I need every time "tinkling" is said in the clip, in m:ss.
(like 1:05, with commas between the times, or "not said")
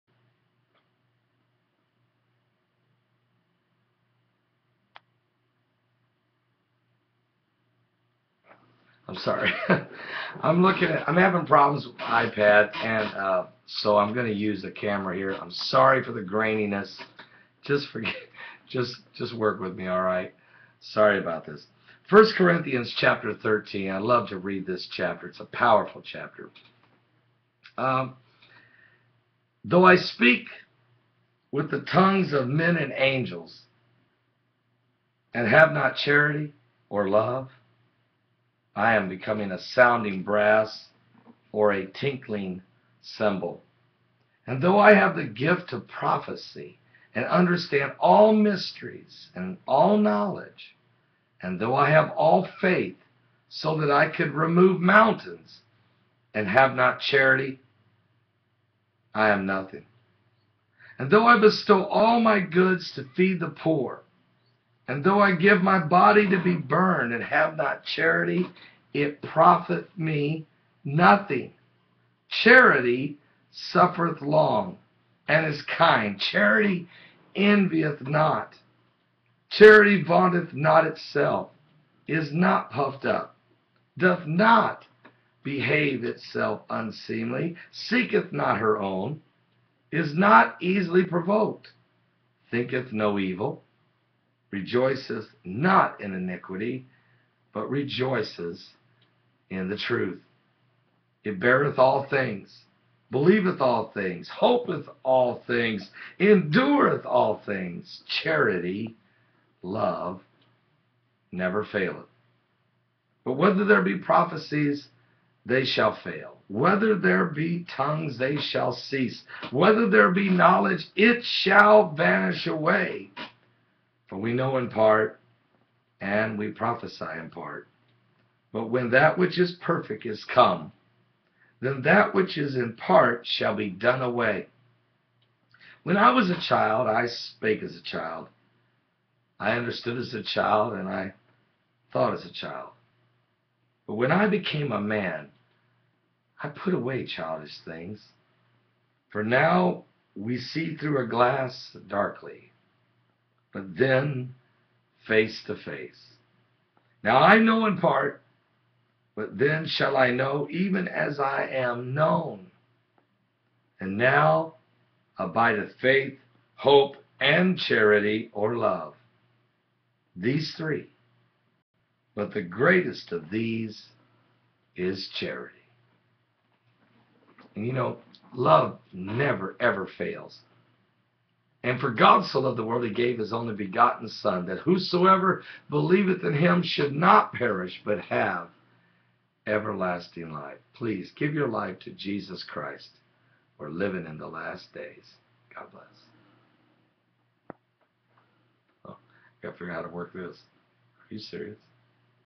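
0:41.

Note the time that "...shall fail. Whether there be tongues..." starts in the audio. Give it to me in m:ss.
1:55.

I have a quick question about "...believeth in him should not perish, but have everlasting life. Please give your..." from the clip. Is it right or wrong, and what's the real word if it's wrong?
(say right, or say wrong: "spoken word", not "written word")
right.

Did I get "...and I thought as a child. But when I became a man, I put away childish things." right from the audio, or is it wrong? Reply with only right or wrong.
right.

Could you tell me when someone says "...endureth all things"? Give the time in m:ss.
1:46.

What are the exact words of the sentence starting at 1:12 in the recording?
Charity suffereth long and is kind.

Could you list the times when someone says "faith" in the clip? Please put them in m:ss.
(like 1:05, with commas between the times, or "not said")
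0:52, 2:45.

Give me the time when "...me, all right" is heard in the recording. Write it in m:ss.
0:19.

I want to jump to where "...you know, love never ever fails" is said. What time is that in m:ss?
2:57.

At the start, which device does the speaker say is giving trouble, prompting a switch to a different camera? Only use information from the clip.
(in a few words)
iPad.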